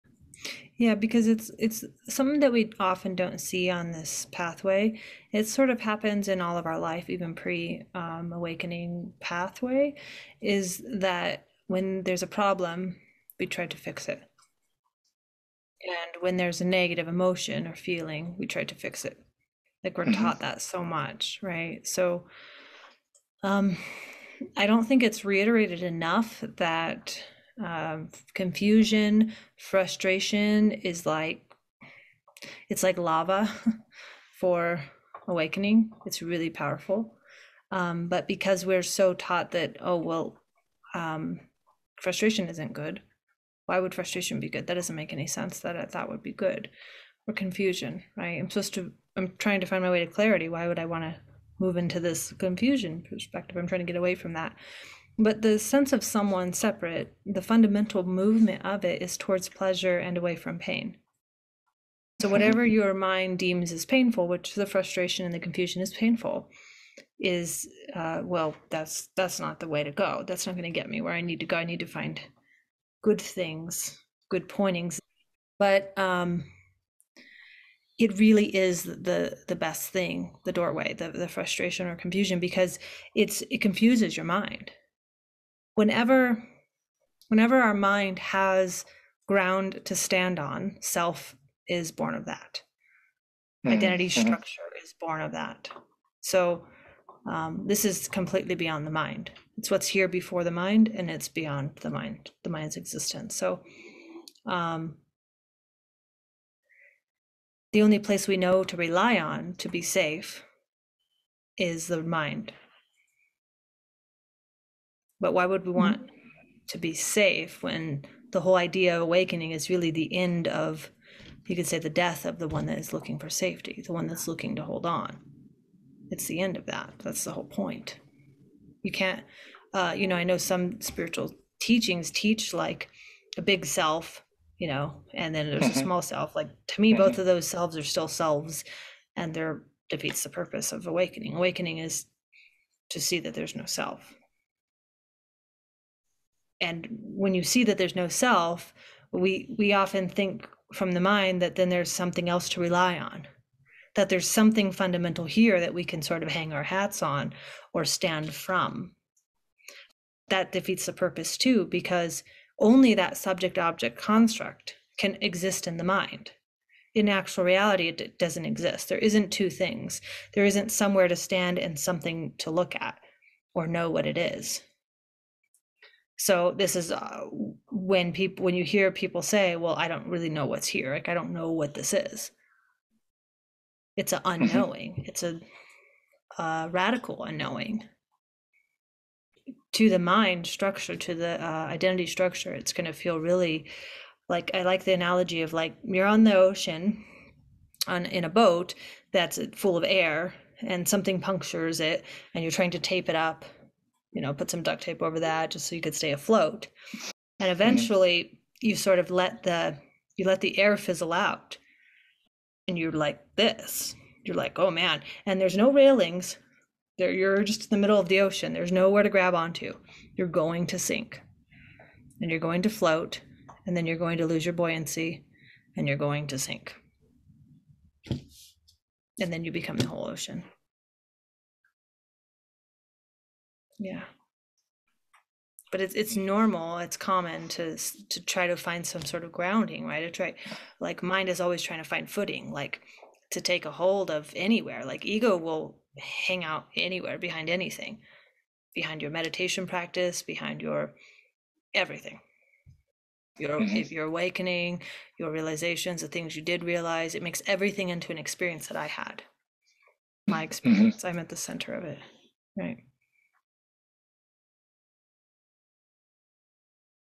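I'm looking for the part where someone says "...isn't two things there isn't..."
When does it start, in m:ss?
2:48.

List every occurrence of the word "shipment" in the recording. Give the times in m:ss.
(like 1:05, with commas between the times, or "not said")
not said.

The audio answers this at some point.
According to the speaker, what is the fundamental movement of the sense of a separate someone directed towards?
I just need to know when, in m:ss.
0:59.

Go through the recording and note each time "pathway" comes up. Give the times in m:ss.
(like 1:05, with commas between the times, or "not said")
0:04, 0:09.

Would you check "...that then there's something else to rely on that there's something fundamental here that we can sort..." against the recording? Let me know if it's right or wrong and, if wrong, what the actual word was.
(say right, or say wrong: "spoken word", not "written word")
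right.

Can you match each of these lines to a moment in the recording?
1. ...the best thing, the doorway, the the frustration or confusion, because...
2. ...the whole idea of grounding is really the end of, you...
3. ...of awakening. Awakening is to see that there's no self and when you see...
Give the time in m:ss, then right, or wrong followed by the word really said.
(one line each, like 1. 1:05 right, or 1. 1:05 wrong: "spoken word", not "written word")
1. 1:19 right
2. 1:58 wrong: "awakening", not "grounding"
3. 2:20 right.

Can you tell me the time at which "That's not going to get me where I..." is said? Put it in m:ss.
1:10.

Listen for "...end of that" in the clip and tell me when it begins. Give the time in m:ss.
2:06.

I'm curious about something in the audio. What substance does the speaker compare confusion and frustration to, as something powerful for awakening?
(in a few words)
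lava.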